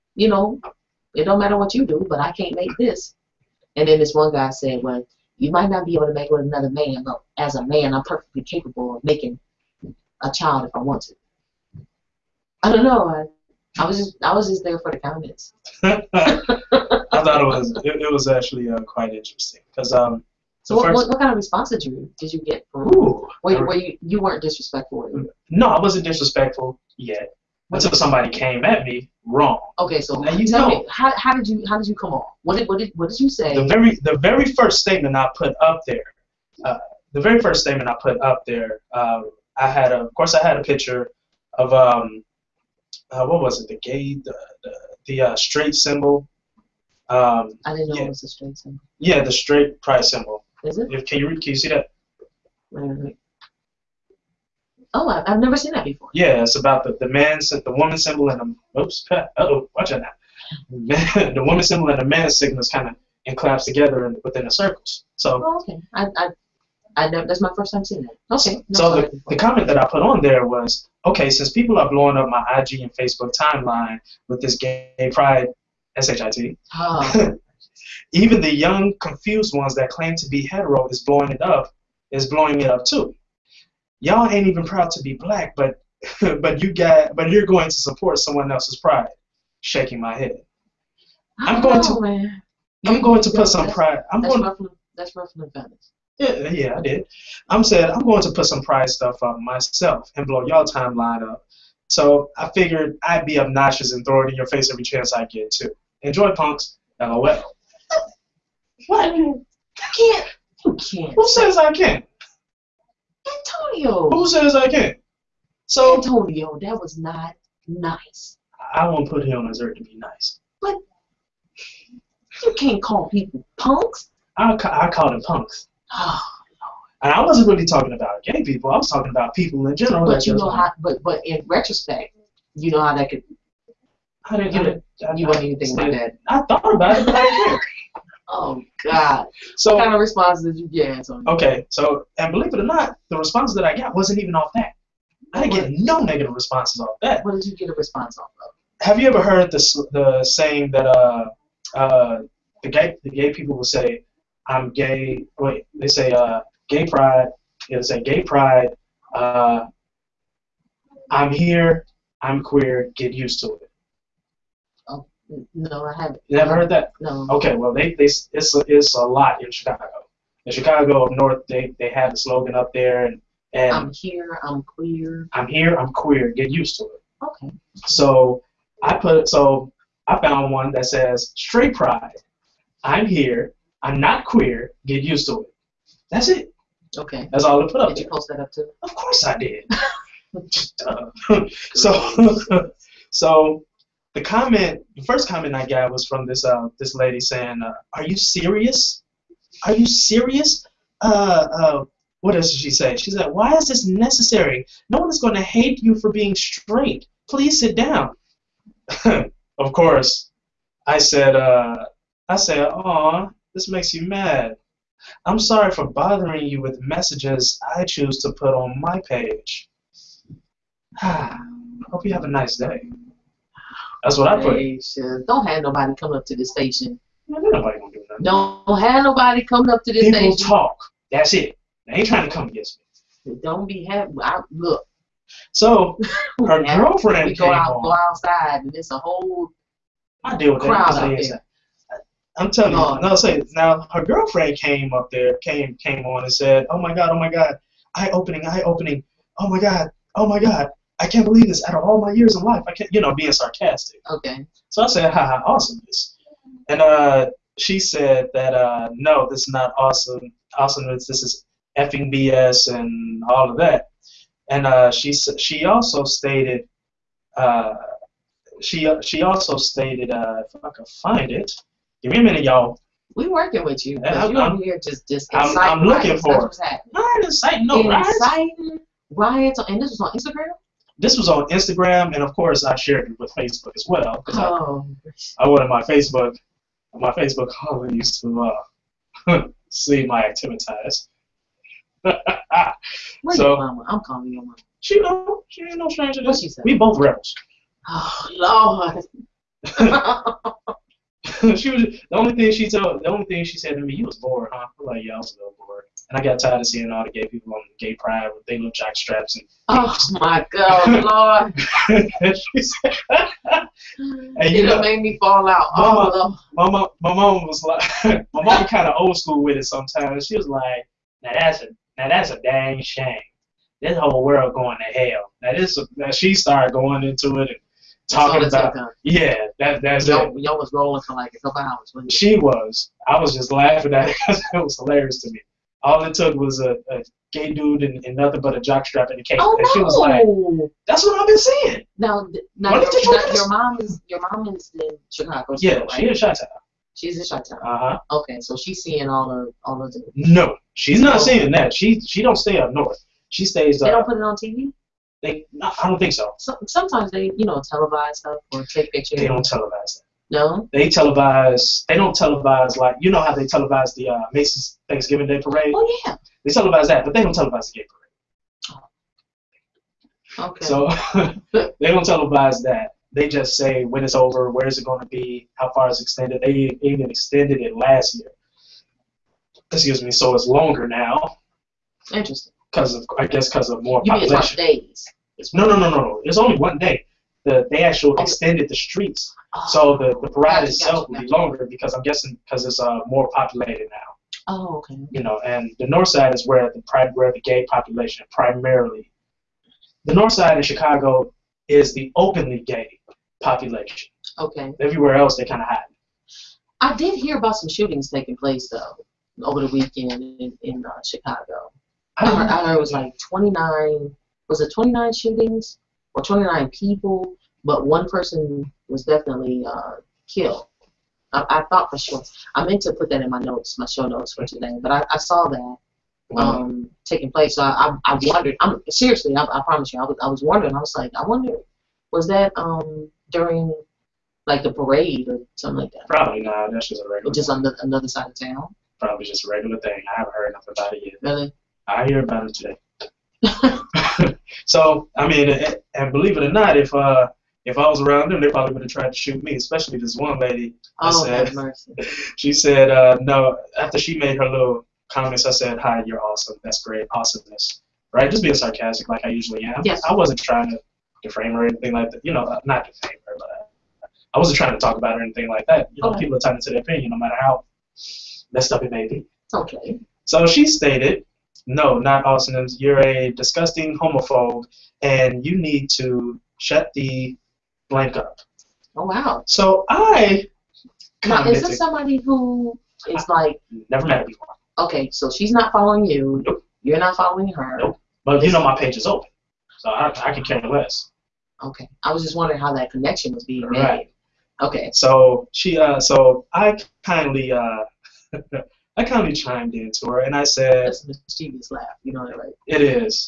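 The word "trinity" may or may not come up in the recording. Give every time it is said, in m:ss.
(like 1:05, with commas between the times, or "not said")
not said.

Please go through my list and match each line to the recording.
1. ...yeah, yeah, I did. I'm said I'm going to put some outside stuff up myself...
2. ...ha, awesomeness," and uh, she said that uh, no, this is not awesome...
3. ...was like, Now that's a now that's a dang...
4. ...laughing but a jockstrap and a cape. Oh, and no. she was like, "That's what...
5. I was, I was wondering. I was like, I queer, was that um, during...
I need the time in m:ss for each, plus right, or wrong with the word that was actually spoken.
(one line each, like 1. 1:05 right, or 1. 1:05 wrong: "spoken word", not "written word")
1. 1:36 wrong: "pride", not "outside"
2. 4:15 right
3. 5:20 right
4. 5:38 wrong: "nothing", not "laughing"
5. 7:10 wrong: "wonder", not "queer".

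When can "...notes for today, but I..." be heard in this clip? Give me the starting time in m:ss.
7:04.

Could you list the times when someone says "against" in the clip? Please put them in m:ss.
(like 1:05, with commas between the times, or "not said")
3:52.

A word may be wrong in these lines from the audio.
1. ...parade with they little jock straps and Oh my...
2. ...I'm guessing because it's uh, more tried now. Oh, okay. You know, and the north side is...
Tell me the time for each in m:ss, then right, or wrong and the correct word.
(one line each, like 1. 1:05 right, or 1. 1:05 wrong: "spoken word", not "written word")
1. 5:07 wrong: "pride", not "parade"
2. 6:31 wrong: "populated", not "tried".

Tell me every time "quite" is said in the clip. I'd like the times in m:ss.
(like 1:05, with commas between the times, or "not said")
0:18.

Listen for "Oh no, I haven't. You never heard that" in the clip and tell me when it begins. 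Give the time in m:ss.
2:44.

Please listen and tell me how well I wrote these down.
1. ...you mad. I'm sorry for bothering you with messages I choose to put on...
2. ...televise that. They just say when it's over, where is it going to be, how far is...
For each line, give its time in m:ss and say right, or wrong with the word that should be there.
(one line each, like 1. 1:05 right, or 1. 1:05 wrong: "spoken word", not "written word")
1. 3:33 right
2. 6:12 right.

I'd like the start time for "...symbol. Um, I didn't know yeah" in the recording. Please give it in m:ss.
0:45.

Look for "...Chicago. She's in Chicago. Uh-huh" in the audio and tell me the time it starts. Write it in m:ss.
5:46.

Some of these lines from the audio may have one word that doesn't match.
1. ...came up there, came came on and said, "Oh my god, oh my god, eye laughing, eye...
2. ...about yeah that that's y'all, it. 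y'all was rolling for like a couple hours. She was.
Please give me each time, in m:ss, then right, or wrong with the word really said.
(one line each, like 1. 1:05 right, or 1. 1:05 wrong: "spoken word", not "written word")
1. 4:04 wrong: "opening", not "laughing"
2. 5:28 right.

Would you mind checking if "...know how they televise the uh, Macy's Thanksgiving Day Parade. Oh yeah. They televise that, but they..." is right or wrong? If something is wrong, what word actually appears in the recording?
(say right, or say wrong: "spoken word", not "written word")
right.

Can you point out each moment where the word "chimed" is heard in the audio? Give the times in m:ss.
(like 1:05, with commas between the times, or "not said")
8:19.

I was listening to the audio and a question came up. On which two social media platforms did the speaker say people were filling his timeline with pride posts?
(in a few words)
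IG and Facebook.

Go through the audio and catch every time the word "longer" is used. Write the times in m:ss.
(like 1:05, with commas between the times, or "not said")
6:20, 6:31.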